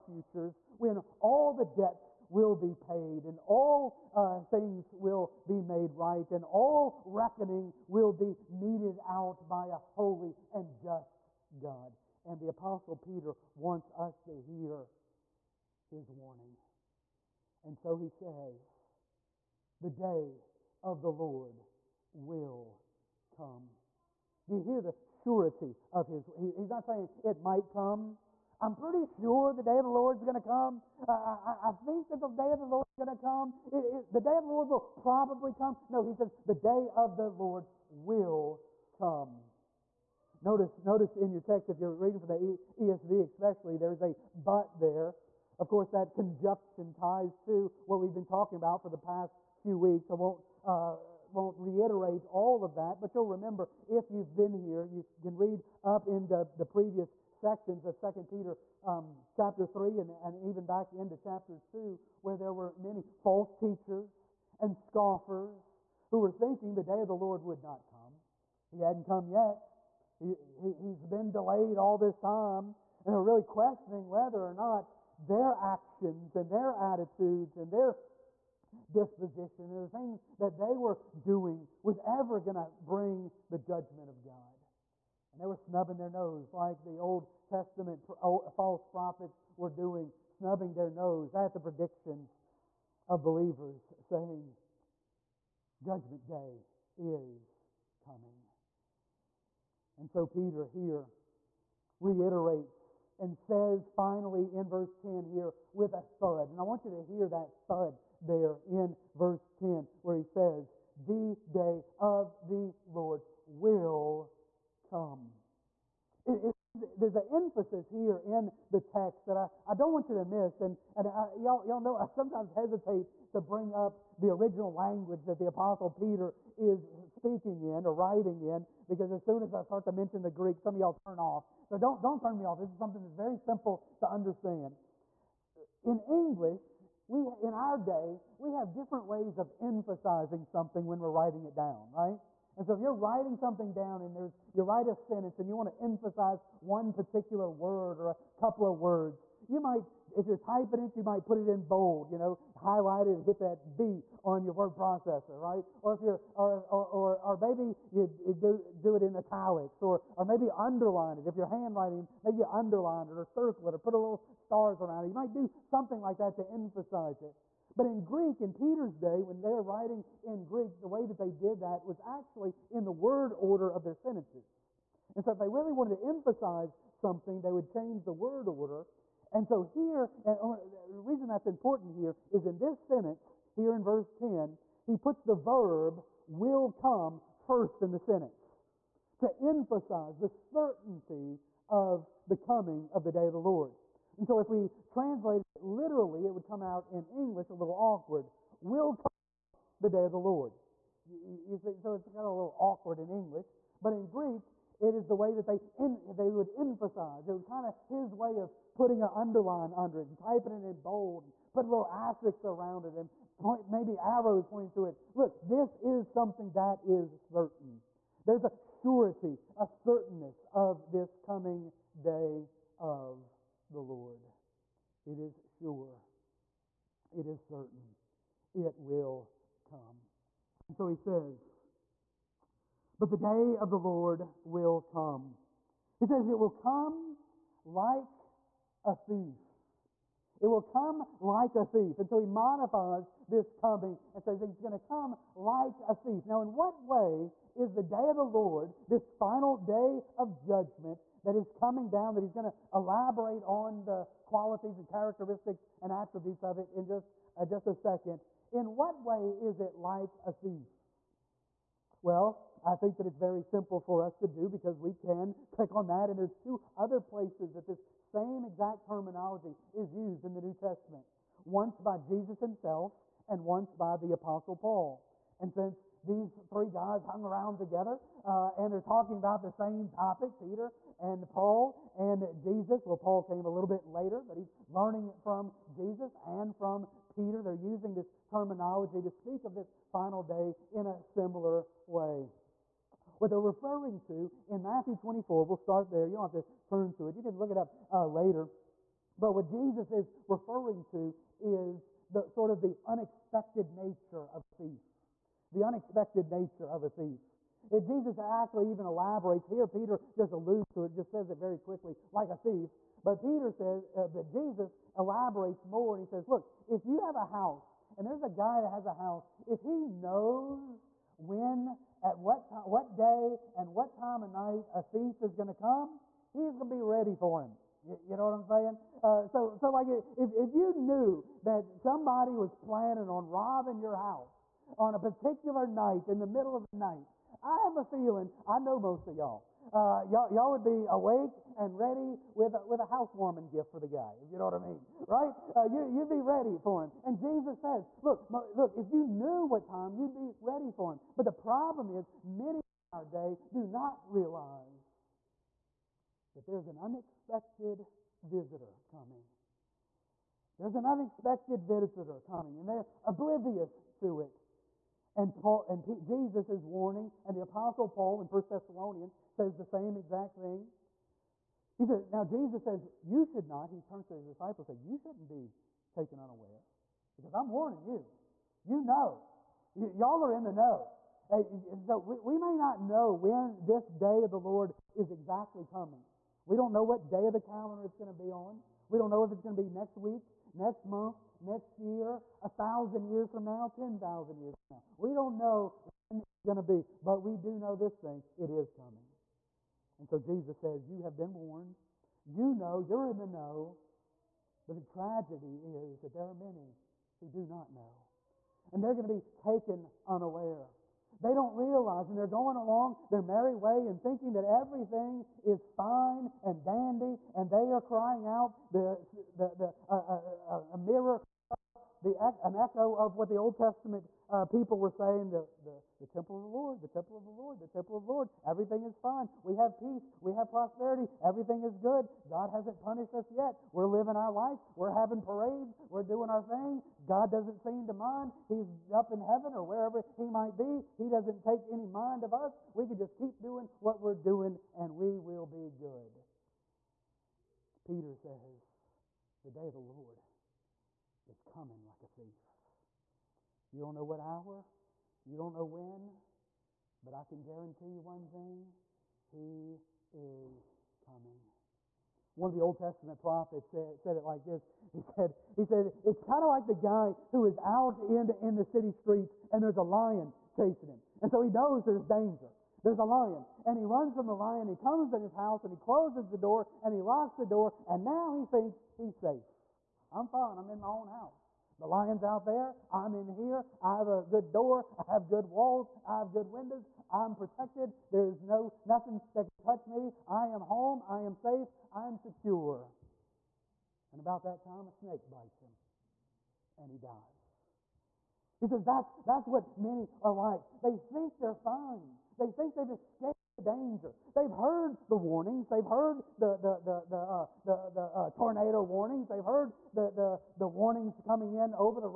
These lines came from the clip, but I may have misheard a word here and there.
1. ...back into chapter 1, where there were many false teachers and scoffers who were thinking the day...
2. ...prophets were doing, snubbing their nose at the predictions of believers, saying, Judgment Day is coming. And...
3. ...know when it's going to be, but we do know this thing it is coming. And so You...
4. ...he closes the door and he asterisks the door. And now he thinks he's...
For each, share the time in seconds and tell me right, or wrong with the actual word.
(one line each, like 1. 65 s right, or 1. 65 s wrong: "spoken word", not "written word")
1. 60 s wrong: "2", not "1"
2. 88 s right
3. 395 s wrong: "Jesus", not "You"
4. 475 s wrong: "locks", not "asterisks".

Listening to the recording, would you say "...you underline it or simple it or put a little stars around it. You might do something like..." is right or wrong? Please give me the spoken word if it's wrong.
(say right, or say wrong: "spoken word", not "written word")
wrong: "circle", not "simple".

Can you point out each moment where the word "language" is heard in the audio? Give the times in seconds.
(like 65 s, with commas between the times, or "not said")
124 s.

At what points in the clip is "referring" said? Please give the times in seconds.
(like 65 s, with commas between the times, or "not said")
293 s, 300 s.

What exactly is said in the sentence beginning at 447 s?
Peter says, The day of the Lord is coming like a thief.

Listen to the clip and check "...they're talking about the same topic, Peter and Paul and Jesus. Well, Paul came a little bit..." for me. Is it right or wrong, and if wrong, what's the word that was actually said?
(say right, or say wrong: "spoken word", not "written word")
right.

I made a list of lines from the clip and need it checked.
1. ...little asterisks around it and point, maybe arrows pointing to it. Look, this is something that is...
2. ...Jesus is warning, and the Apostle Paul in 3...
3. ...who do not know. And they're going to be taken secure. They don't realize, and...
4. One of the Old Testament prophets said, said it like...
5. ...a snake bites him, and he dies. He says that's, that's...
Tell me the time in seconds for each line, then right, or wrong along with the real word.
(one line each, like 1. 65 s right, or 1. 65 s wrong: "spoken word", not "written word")
1. 211 s right
2. 366 s wrong: "1", not "3"
3. 407 s wrong: "unaware", not "secure"
4. 462 s right
5. 494 s right.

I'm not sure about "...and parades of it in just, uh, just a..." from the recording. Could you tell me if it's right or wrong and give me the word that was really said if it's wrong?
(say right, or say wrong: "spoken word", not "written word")
wrong: "attributes", not "parades".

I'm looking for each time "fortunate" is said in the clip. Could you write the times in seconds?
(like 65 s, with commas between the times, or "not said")
not said.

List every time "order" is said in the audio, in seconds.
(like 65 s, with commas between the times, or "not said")
173 s, 178 s.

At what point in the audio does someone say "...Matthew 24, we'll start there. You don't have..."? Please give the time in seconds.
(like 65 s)
294 s.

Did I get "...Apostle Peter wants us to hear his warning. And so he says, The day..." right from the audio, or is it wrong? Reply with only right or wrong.
right.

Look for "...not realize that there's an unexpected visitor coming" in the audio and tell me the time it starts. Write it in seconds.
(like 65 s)
353 s.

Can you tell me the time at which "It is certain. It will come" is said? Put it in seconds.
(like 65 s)
227 s.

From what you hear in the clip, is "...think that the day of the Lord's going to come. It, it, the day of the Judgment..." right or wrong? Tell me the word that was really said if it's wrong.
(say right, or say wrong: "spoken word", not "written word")
wrong: "Lord", not "Judgment".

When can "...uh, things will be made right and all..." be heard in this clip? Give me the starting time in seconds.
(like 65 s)
4 s.